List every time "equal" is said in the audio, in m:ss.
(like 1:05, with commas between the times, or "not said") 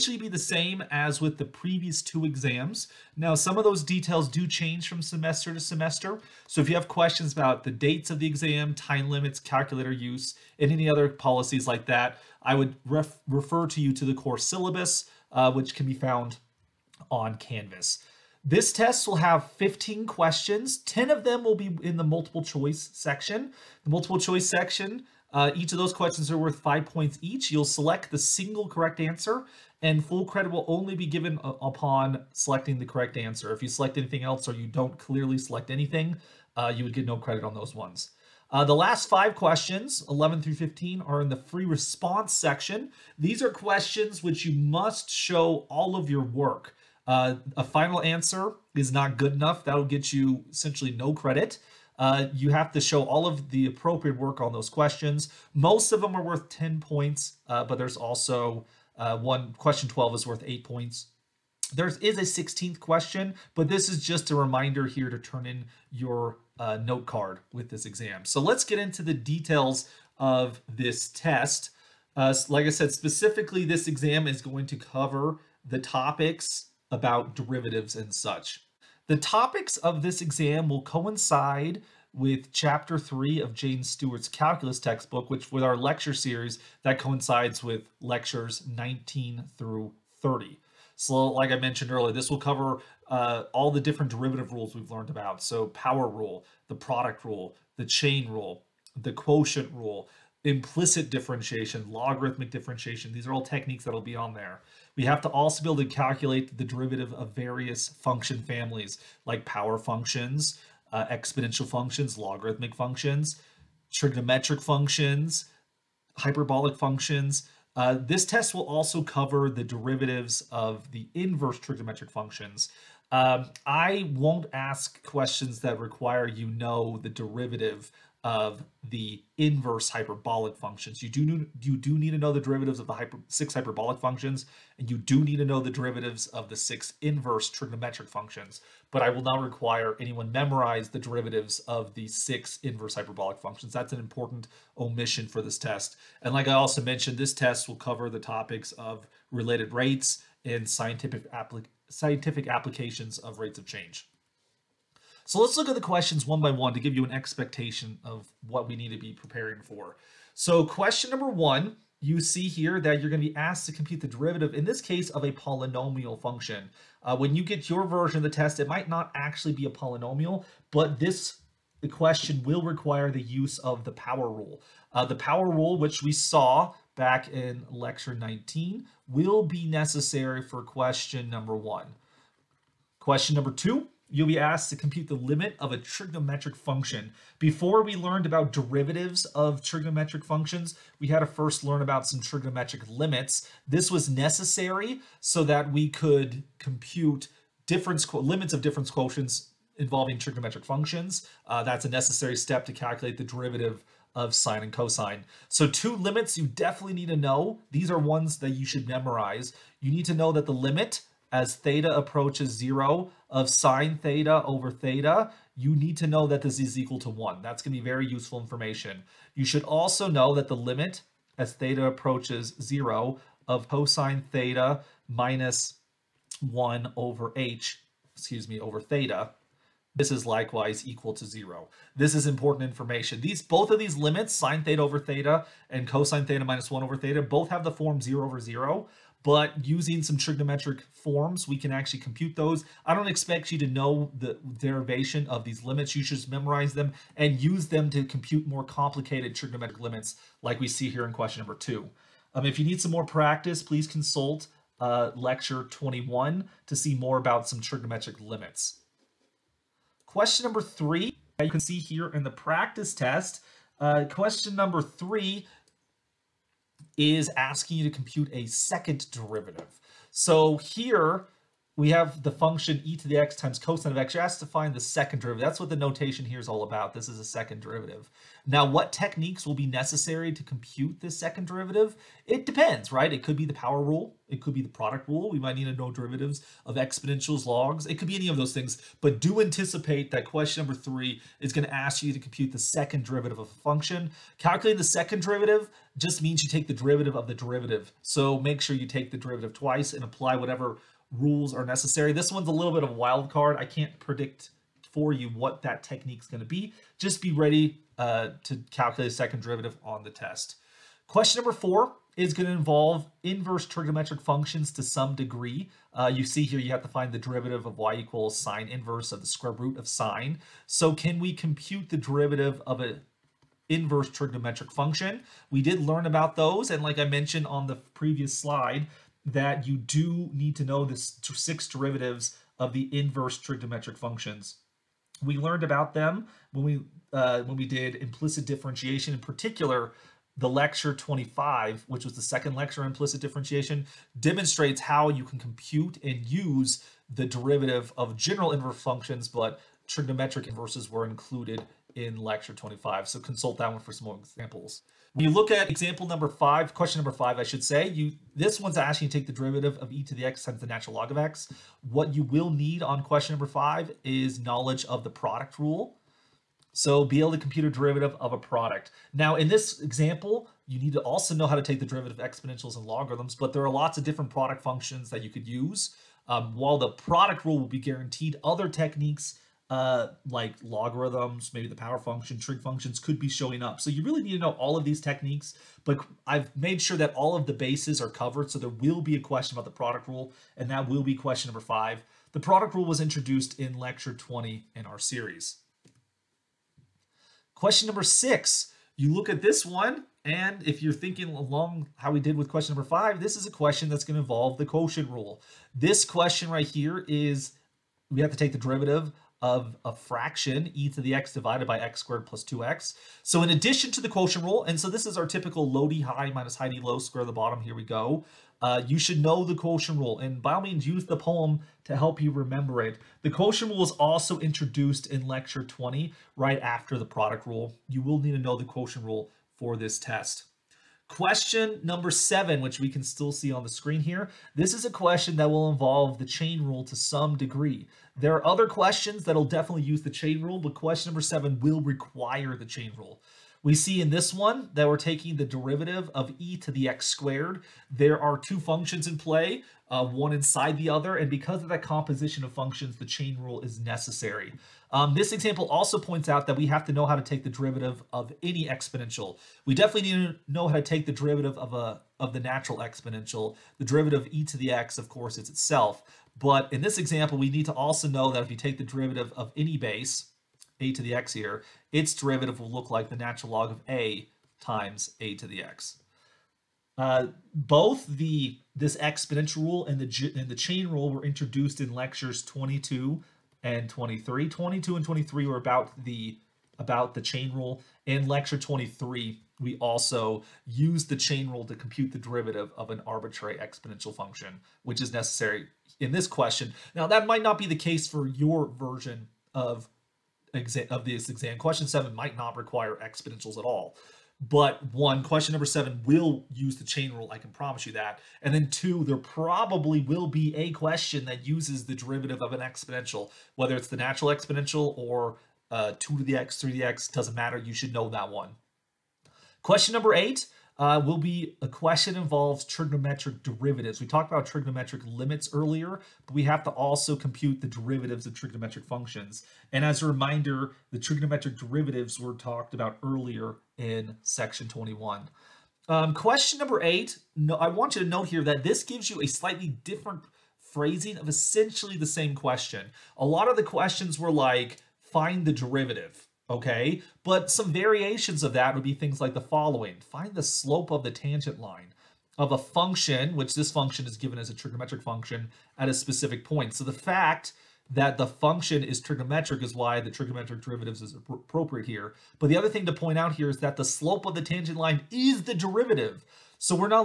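3:36, 3:50, 5:17.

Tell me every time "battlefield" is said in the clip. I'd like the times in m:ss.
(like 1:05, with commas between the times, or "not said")
not said.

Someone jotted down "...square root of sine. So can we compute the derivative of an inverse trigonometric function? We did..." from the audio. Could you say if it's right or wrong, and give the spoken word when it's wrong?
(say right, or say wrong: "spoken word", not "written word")
right.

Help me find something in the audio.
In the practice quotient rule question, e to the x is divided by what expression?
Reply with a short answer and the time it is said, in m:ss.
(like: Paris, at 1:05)
x squared plus 2x, at 6:51.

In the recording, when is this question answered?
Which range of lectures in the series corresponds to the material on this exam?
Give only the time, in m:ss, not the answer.
1:28.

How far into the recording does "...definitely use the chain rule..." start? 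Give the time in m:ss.
7:19.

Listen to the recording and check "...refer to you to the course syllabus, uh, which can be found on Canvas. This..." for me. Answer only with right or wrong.
right.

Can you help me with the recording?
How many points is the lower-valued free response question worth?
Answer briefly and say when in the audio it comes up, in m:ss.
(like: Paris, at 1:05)
8 points, at 1:00.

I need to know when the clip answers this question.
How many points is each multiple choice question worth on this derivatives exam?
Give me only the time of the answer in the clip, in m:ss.
0:26.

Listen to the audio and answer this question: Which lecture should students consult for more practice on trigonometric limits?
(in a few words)
21.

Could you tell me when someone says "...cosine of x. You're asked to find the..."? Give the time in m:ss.
4:33.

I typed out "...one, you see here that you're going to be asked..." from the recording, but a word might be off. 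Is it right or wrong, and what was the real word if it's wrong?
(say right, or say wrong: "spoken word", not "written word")
right.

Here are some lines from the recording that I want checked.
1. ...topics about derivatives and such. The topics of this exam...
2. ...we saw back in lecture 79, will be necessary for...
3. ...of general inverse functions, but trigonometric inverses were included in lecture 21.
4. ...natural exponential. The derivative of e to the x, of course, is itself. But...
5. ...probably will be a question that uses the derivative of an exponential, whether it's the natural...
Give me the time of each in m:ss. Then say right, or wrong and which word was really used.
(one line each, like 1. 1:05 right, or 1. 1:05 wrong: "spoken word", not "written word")
1. 1:15 right
2. 2:56 wrong: "19", not "79"
3. 5:47 wrong: "25", not "21"
4. 7:42 right
5. 8:29 right.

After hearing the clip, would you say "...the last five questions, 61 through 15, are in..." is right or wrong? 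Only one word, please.
wrong.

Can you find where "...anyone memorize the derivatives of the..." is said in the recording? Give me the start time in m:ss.
2:20.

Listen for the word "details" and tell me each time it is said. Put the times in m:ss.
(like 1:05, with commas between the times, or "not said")
0:03, 1:09.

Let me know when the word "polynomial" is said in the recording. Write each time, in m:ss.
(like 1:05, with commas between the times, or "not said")
2:45, 2:49.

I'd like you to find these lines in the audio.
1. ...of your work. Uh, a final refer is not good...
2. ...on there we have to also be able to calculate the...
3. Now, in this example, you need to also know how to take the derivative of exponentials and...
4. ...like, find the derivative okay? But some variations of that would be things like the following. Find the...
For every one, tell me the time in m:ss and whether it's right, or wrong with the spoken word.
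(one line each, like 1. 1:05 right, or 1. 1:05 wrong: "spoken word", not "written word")
1. 0:45 wrong: "answer", not "refer"
2. 1:44 right
3. 6:09 right
4. 9:04 right.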